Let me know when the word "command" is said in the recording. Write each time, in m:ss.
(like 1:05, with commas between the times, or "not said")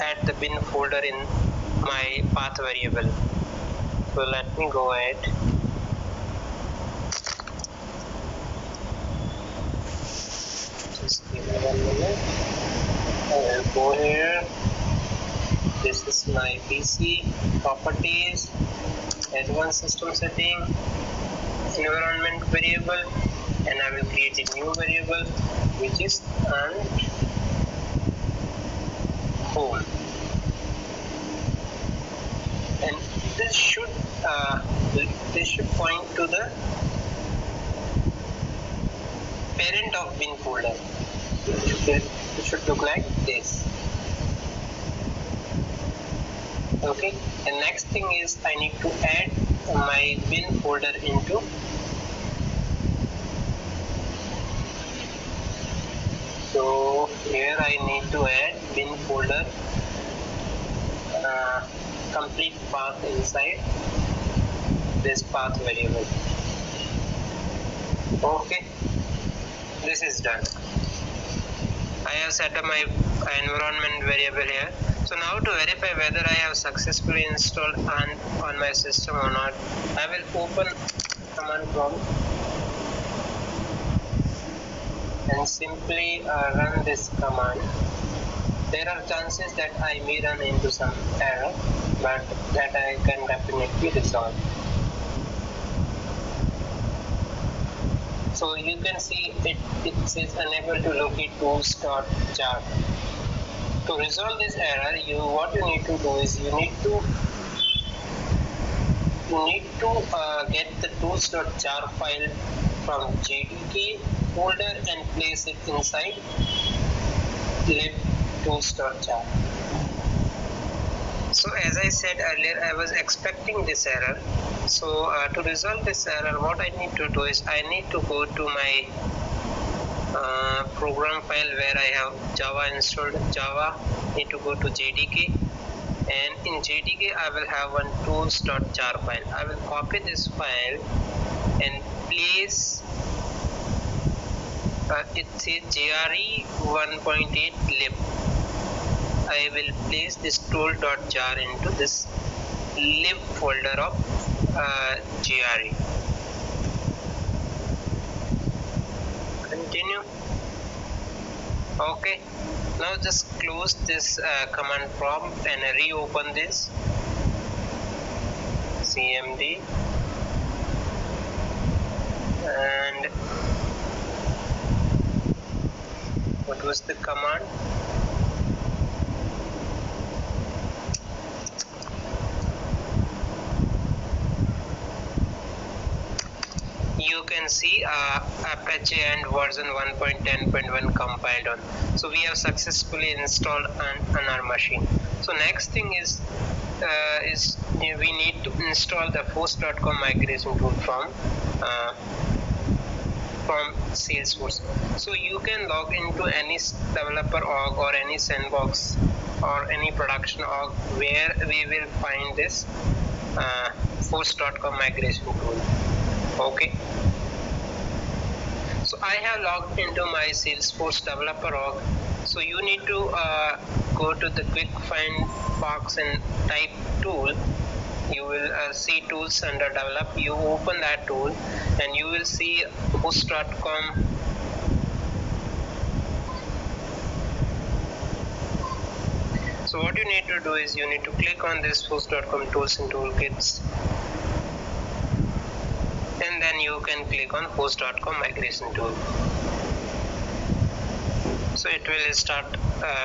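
1:21, 1:27, 2:44, 2:56.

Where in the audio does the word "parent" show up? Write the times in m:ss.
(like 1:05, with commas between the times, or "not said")
0:39.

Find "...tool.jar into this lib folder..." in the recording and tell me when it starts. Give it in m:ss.
2:30.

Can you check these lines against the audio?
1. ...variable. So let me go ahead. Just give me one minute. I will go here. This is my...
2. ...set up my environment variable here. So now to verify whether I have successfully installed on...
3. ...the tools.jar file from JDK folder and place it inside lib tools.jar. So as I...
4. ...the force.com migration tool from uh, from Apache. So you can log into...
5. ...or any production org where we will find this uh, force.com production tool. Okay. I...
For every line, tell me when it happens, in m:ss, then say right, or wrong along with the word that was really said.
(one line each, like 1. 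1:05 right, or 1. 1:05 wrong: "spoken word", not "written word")
1. 0:02 right
2. 1:12 right
3. 1:50 right
4. 3:19 wrong: "Salesforce", not "Apache"
5. 3:29 wrong: "migration", not "production".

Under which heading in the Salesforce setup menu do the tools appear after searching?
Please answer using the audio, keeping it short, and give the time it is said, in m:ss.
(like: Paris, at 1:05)
develop, at 3:49.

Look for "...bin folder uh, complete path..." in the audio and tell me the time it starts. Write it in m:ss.
0:58.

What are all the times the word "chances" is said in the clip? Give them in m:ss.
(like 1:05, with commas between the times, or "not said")
1:29.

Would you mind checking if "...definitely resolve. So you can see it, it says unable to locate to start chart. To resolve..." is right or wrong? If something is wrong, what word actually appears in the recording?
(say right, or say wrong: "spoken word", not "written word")
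right.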